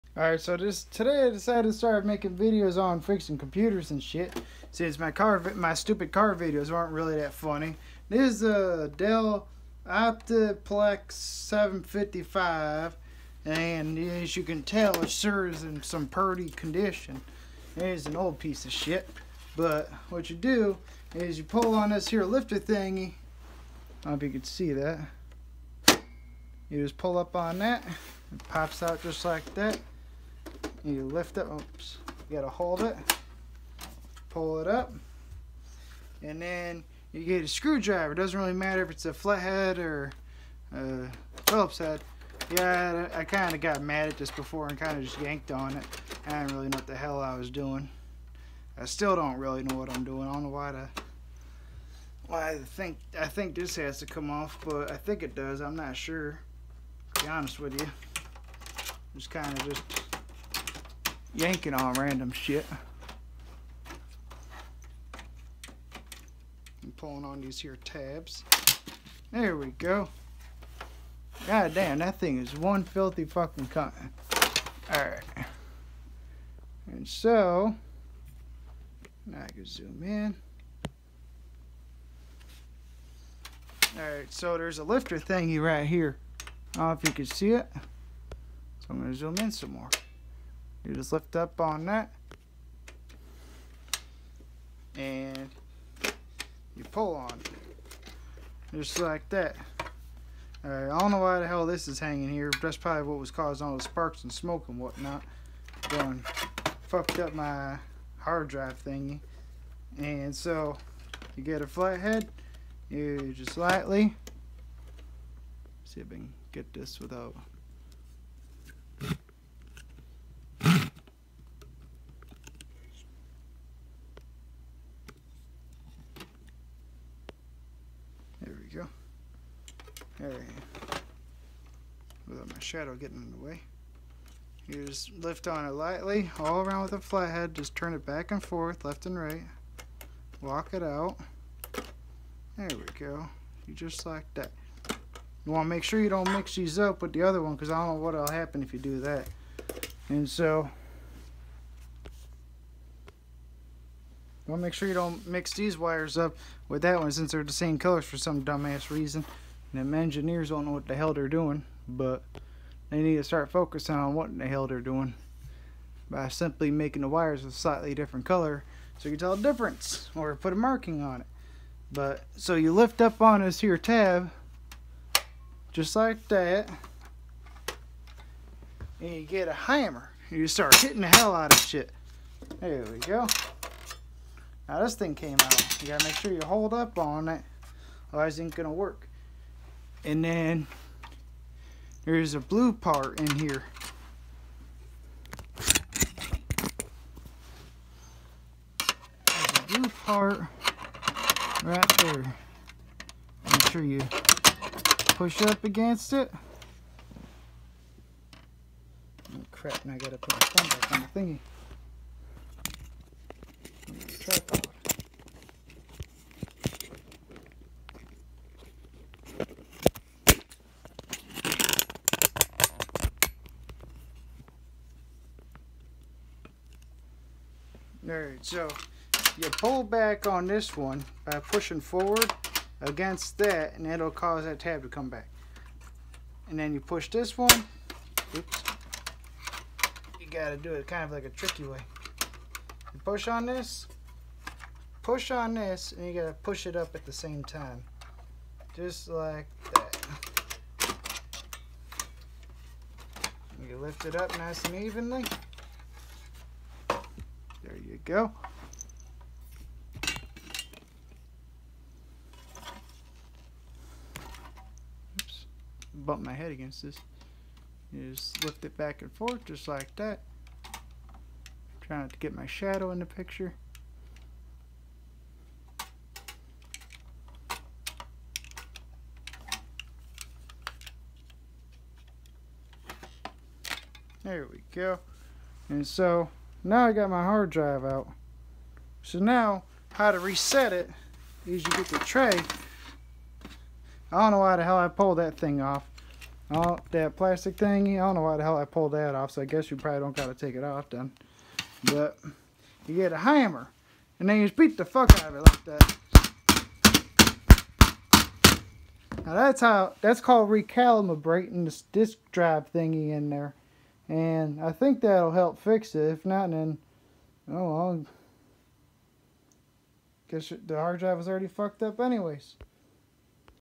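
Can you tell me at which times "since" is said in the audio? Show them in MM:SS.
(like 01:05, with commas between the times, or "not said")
00:04, 02:37.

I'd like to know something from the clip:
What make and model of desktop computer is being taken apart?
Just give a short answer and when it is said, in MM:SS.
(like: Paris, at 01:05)
Dell Optiplex 755, at 00:08.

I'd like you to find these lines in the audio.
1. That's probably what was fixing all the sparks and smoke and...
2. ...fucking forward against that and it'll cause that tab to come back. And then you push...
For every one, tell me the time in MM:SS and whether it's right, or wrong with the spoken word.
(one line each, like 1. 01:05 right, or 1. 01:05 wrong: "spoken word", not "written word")
1. 01:42 wrong: "causing", not "fixing"
2. 03:51 wrong: "pushing", not "fucking".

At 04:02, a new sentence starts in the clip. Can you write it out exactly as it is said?
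You push on this, push on this, and you gotta push it up at the same time.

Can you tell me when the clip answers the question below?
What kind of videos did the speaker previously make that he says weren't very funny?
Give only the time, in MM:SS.
00:06.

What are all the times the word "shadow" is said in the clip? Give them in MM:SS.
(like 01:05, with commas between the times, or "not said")
02:12, 04:32.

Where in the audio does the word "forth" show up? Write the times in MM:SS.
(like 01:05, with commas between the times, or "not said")
02:18, 04:29.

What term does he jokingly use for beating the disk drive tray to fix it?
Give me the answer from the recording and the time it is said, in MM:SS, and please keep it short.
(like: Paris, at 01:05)
recalibrating, at 05:10.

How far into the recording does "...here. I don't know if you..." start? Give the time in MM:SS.
01:25.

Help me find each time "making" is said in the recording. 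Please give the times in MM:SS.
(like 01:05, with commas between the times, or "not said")
00:02, 02:46.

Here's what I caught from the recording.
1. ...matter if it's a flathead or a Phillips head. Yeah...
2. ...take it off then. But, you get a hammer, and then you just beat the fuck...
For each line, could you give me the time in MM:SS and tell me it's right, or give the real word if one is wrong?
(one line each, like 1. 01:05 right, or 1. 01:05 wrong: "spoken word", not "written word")
1. 00:38 right
2. 05:00 right.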